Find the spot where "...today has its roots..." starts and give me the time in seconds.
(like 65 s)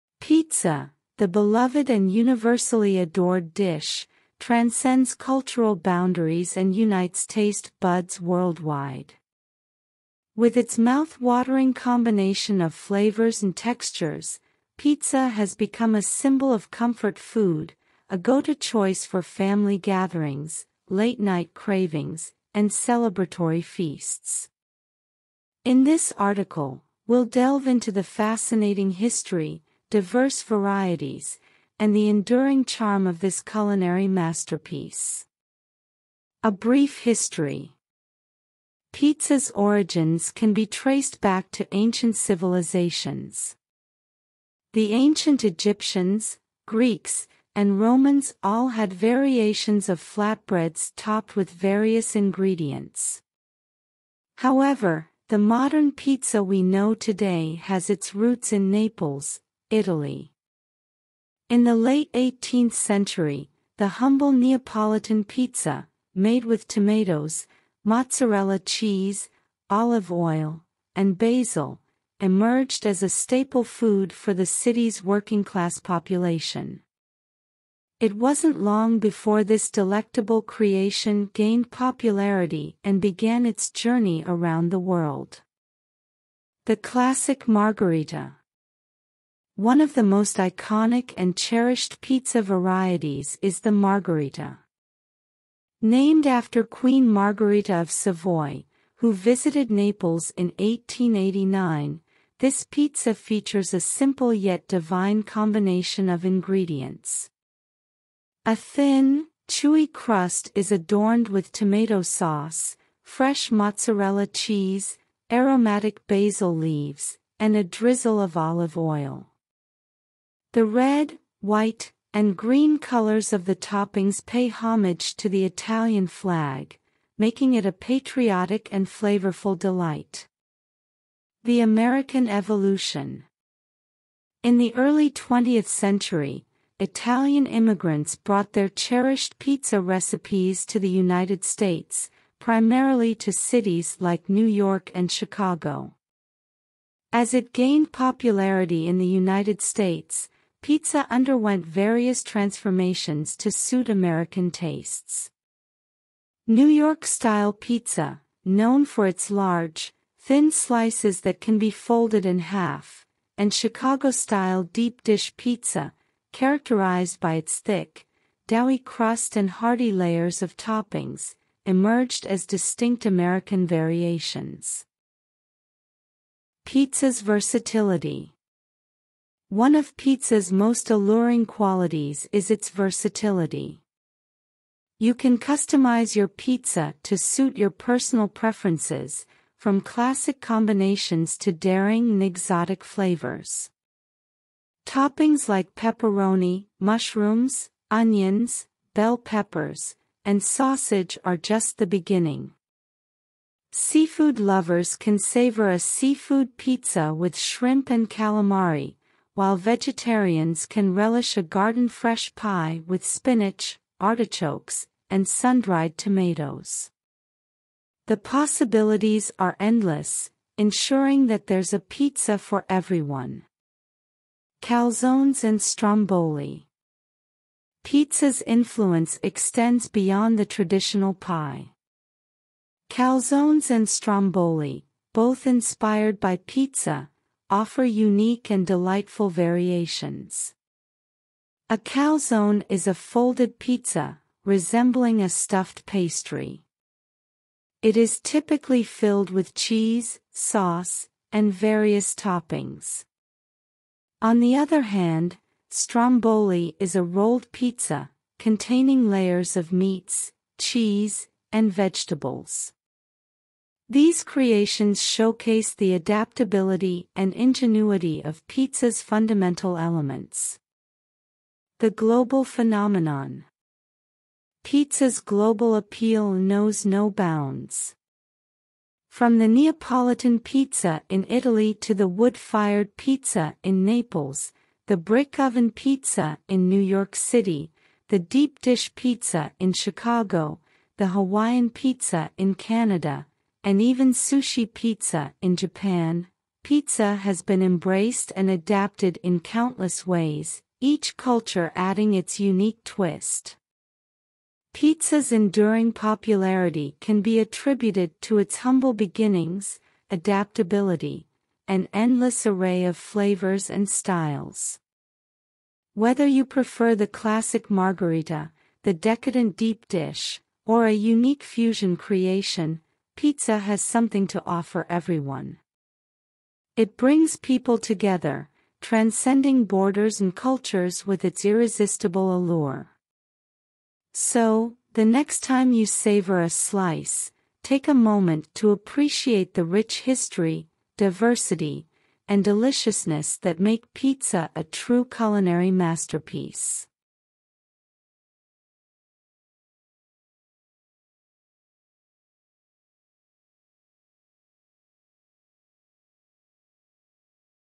56 s.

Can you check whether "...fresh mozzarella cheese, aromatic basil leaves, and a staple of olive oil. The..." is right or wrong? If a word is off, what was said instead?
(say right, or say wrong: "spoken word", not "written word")
wrong: "drizzle", not "staple".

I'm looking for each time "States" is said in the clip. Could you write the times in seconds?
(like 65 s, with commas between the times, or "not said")
141 s, 149 s.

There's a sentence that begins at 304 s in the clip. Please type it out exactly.
Pizza's enduring popularity can be attributed to its humble beginnings, adaptability, and endless array of flavors and styles.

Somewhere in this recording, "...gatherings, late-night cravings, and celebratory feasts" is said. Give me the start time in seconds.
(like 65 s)
19 s.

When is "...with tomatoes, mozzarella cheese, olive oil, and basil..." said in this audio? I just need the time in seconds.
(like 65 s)
66 s.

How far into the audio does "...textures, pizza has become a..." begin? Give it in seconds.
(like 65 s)
13 s.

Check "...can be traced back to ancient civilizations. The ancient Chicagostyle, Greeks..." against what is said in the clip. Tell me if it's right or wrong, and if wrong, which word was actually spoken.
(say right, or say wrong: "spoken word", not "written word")
wrong: "Egyptians", not "Chicagostyle".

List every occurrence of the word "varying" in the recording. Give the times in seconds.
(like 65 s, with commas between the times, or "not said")
not said.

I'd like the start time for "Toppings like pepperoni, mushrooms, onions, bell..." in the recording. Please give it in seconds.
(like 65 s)
194 s.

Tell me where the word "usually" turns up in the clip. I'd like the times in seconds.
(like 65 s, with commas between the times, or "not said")
not said.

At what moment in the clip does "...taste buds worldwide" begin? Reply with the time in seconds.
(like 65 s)
7 s.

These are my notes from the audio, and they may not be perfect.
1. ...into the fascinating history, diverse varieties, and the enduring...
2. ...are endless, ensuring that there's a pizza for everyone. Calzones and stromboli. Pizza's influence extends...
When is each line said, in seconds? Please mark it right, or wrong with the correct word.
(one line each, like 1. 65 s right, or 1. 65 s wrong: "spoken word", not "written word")
1. 27 s right
2. 219 s right.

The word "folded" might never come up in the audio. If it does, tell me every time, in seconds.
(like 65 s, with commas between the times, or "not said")
161 s, 242 s.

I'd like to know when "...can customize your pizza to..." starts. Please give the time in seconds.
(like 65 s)
185 s.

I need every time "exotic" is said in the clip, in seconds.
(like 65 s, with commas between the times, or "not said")
192 s.